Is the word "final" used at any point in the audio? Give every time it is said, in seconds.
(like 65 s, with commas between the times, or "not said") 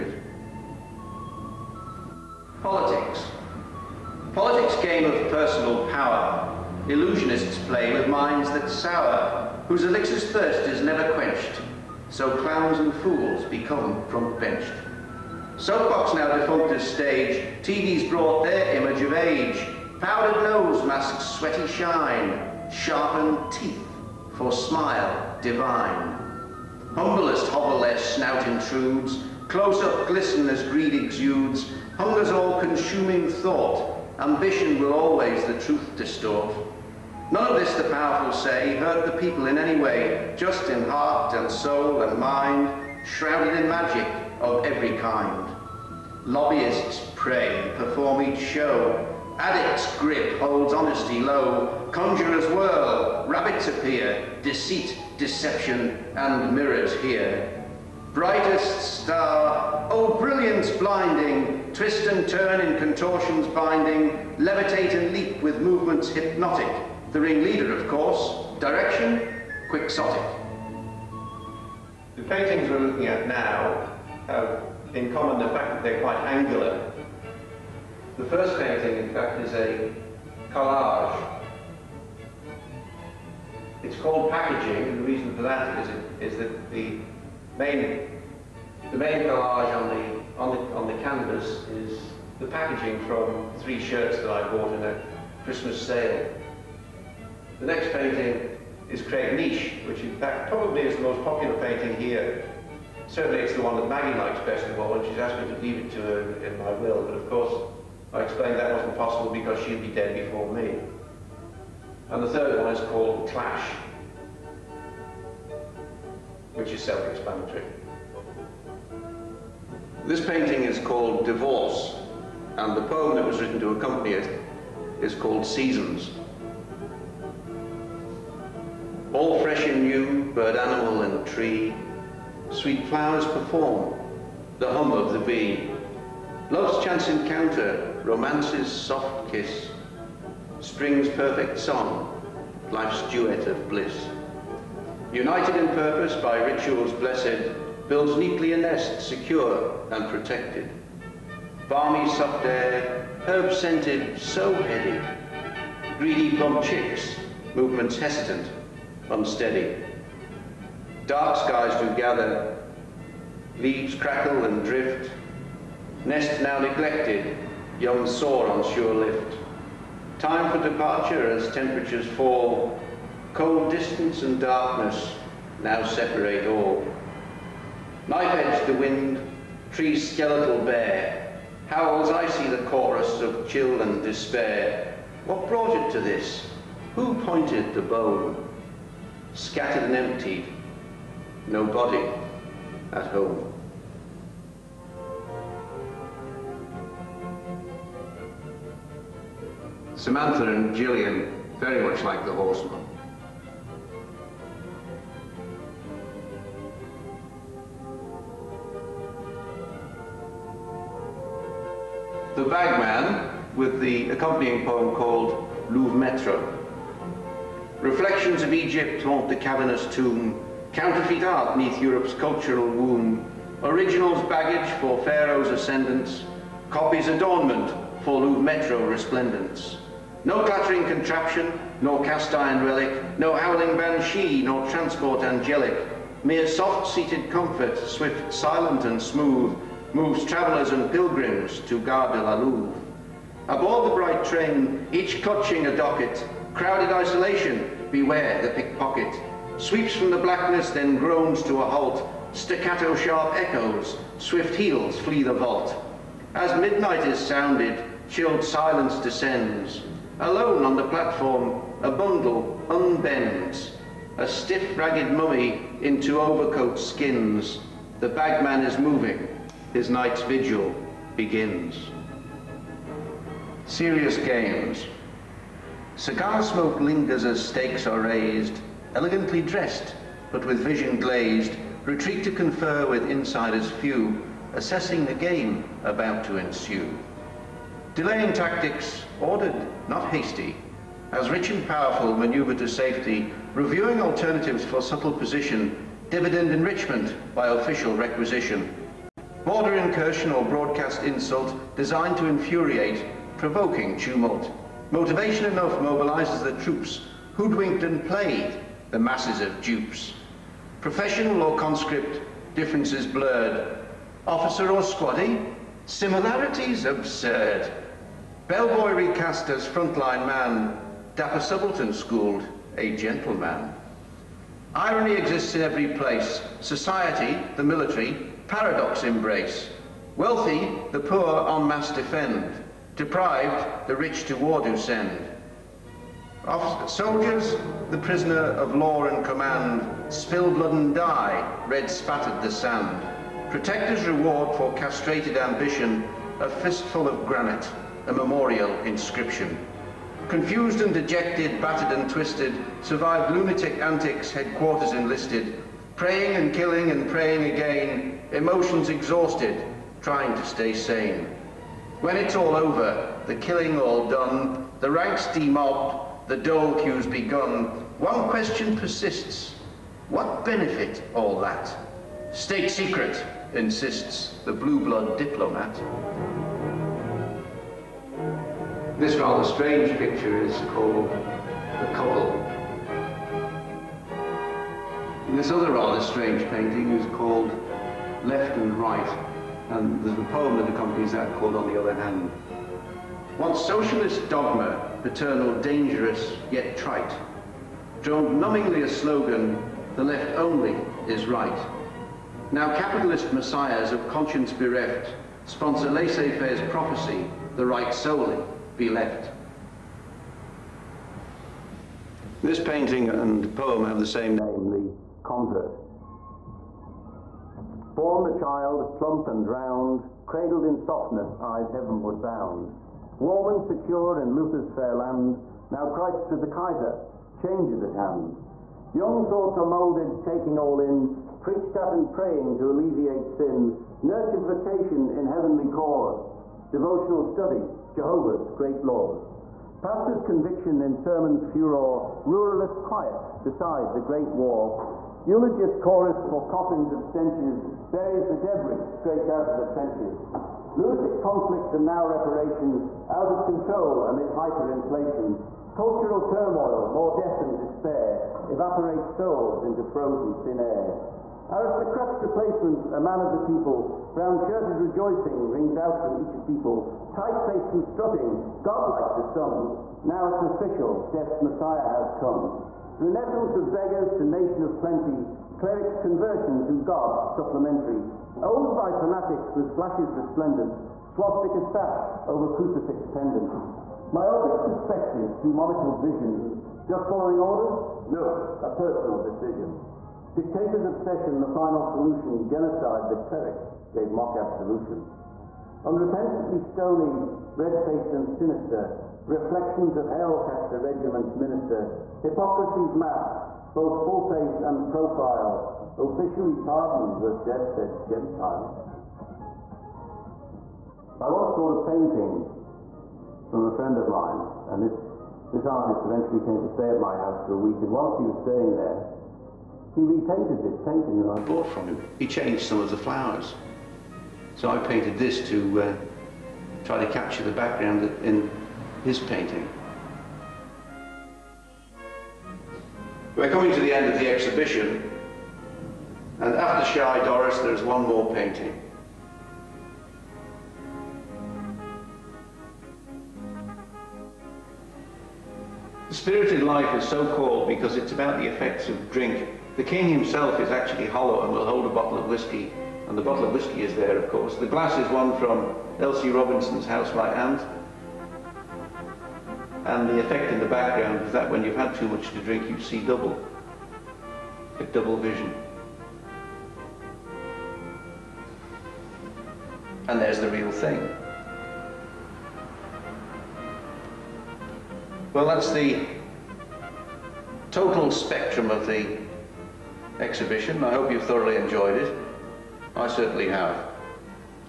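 491 s.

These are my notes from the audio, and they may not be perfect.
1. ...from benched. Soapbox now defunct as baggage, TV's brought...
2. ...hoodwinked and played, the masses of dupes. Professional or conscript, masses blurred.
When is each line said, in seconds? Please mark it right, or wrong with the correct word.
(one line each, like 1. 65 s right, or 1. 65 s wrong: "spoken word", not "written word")
1. 14 s wrong: "stage", not "baggage"
2. 307 s wrong: "differences", not "masses".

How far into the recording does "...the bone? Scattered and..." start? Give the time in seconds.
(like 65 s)
187 s.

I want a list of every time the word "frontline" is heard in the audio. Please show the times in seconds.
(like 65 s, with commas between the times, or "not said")
319 s.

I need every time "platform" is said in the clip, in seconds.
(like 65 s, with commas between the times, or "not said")
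260 s.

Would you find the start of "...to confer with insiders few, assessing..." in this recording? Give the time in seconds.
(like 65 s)
282 s.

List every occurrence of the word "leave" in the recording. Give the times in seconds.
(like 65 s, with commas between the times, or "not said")
105 s, 163 s.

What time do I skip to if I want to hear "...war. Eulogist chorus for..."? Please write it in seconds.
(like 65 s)
444 s.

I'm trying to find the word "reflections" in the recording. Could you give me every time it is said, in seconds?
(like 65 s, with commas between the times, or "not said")
217 s, 499 s.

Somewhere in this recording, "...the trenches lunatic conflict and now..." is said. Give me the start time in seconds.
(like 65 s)
449 s.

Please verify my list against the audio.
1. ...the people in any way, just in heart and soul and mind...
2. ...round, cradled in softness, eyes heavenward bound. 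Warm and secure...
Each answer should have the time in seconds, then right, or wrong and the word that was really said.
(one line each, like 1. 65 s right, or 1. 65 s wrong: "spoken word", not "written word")
1. 39 s right
2. 419 s right.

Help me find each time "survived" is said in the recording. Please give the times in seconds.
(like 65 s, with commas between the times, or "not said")
352 s.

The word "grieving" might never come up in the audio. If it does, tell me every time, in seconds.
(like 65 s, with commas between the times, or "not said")
not said.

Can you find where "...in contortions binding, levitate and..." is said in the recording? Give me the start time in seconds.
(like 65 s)
62 s.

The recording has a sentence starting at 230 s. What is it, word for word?
No clattering contraption, nor cast iron relic, no howling banshee, nor transport angelic.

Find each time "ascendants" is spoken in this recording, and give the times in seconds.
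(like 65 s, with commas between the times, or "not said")
225 s.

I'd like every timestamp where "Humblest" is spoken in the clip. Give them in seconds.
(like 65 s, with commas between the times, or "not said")
26 s.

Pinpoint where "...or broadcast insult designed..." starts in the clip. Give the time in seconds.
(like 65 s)
300 s.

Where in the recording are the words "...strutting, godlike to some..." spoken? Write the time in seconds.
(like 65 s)
467 s.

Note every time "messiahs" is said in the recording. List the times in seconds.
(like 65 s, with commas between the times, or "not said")
403 s, 471 s.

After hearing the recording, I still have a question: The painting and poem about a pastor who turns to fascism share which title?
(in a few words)
The Convert.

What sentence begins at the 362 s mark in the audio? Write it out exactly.
When it's all over, the killing all done, the ranks demobbed, the dole queues begun, one question persists.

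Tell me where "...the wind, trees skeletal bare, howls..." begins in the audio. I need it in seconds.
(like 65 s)
178 s.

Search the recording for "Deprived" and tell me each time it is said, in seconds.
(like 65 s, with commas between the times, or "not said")
332 s.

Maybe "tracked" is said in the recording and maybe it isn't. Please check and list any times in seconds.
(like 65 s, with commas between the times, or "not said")
not said.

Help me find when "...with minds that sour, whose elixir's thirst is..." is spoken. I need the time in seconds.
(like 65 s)
7 s.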